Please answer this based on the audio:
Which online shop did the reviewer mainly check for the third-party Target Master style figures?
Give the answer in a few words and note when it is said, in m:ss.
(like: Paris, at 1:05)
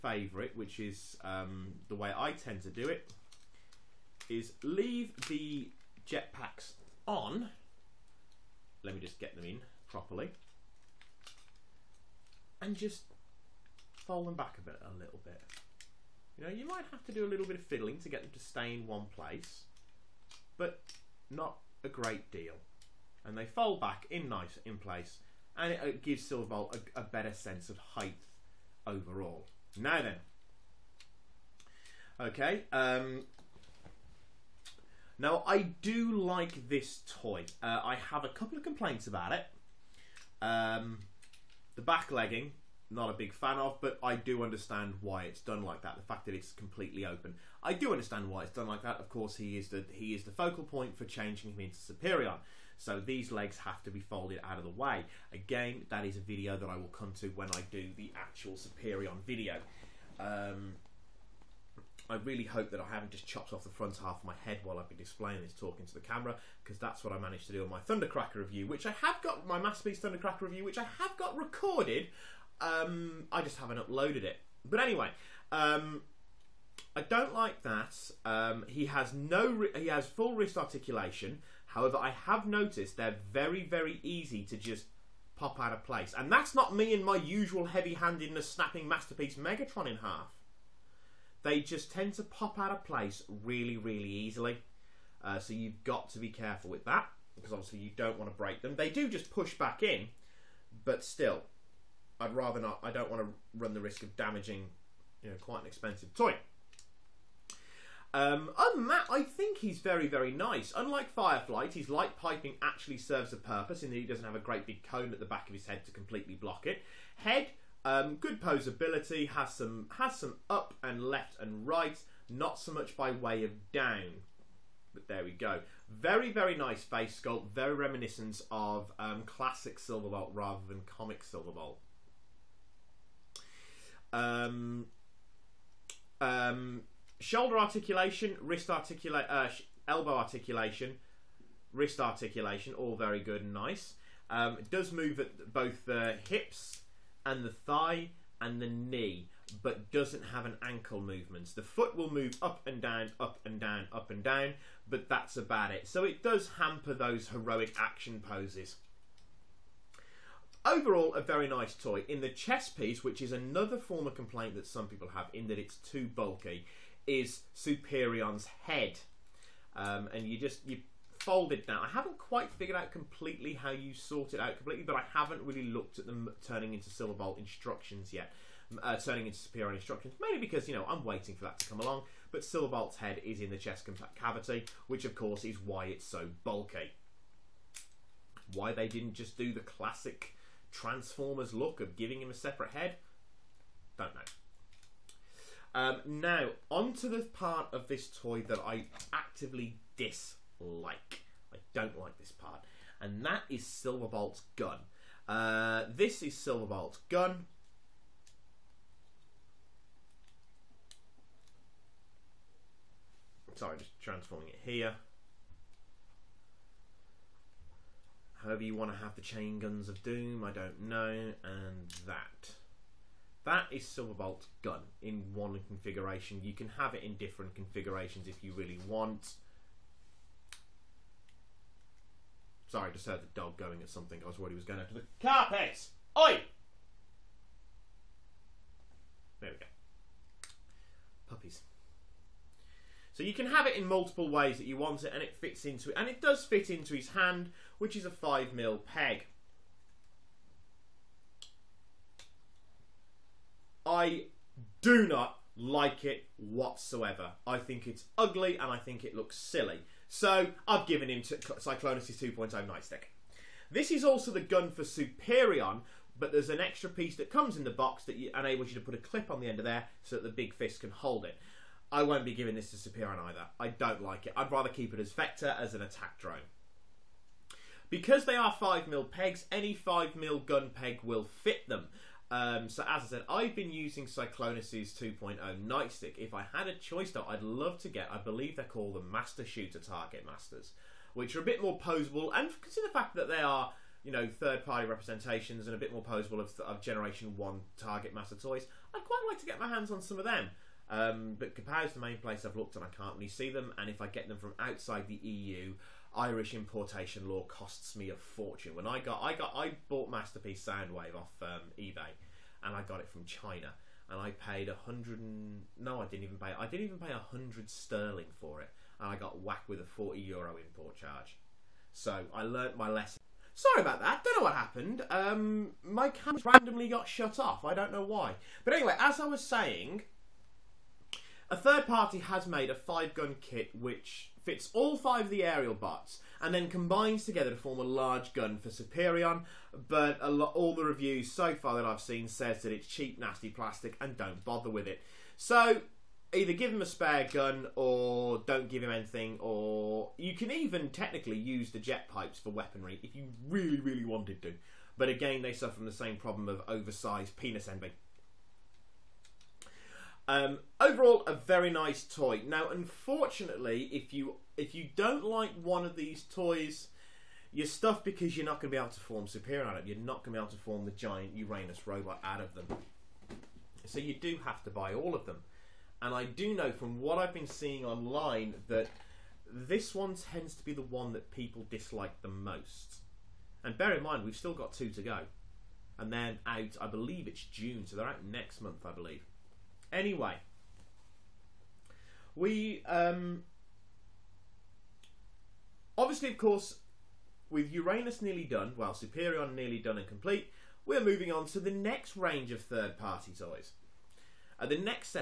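Kapow, at 5:01.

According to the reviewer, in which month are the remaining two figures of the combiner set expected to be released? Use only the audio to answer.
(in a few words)
June.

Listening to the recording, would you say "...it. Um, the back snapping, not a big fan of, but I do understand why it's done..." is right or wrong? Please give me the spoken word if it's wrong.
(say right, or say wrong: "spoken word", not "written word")
wrong: "legging", not "snapping".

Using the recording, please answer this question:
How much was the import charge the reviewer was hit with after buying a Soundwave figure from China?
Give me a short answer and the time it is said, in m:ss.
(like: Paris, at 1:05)
40 euro, at 5:19.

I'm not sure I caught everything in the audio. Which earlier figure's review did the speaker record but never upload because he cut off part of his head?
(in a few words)
Masterpiece Thundercracker.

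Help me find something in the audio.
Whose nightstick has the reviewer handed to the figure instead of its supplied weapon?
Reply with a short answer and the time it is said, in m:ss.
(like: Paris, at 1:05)
Cyclonus, at 4:21.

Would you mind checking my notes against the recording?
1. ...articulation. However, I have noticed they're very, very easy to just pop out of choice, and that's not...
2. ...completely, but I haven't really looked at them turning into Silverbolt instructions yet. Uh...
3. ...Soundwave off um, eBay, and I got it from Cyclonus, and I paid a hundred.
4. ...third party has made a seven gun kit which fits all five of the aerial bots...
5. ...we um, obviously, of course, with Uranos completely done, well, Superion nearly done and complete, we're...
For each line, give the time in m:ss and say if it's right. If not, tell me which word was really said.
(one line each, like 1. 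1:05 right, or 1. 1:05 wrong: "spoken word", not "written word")
1. 1:20 wrong: "place", not "choice"
2. 2:54 right
3. 5:10 wrong: "China", not "Cyclonus"
4. 5:31 wrong: "five", not "seven"
5. 6:32 wrong: "nearly", not "completely".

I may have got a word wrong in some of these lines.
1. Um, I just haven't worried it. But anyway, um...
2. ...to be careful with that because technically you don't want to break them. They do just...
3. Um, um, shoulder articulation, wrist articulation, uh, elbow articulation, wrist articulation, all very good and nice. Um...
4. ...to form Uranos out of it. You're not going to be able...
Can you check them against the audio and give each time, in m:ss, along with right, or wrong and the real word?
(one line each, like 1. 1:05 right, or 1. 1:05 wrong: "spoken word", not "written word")
1. 1:12 wrong: "uploaded", not "worried"
2. 1:36 wrong: "obviously", not "technically"
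3. 2:14 right
4. 6:08 wrong: "Superion", not "Uranos".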